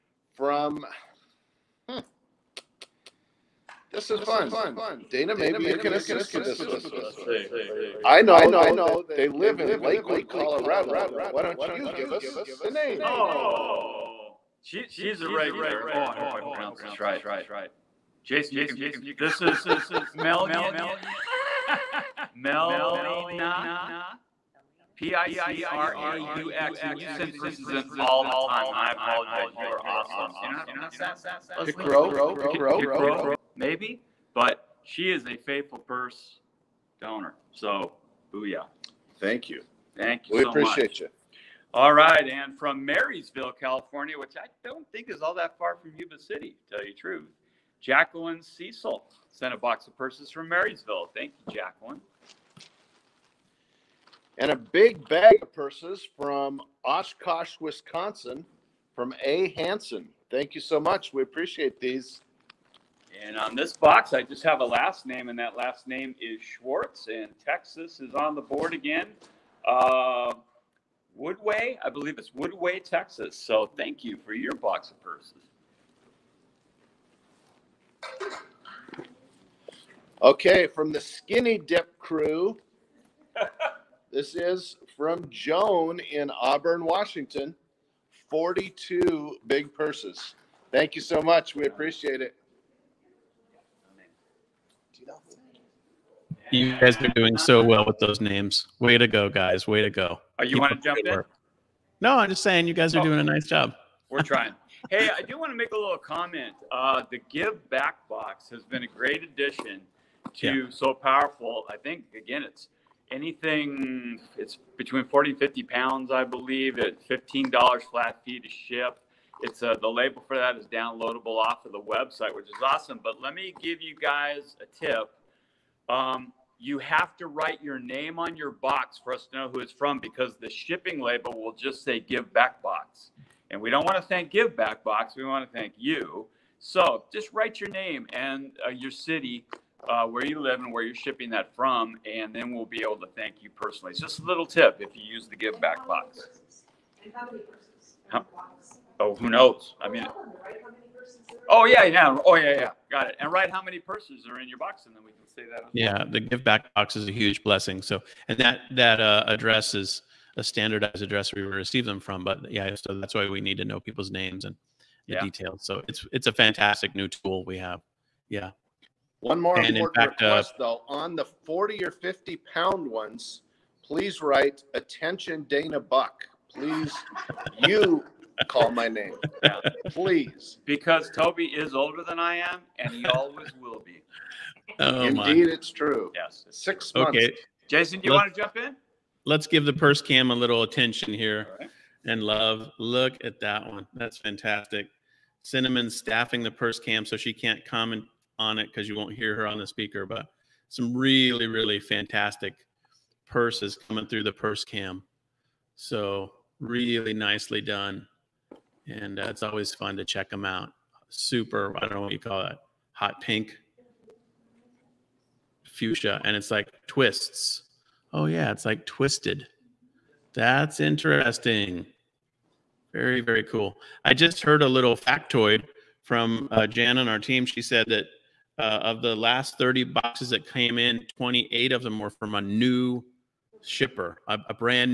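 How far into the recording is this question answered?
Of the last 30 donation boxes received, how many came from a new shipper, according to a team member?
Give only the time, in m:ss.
3:51.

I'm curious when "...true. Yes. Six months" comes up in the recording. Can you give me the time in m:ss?
3:05.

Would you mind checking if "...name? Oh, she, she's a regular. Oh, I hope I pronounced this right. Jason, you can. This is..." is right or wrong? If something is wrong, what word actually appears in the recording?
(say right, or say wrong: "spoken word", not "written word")
right.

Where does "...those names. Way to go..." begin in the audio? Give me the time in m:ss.
1:37.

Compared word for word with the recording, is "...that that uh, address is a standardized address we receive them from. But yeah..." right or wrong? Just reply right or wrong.
right.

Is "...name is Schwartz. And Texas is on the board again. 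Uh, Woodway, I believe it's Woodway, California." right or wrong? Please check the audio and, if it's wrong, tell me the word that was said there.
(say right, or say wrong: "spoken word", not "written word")
wrong: "Texas", not "California".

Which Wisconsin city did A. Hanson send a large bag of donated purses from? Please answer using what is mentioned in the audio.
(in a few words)
Oshkosh.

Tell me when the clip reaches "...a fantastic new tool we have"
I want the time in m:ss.
2:46.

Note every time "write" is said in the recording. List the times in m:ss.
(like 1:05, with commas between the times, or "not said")
2:07, 2:17, 2:33, 2:54.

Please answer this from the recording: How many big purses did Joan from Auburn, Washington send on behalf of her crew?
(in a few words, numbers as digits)
42.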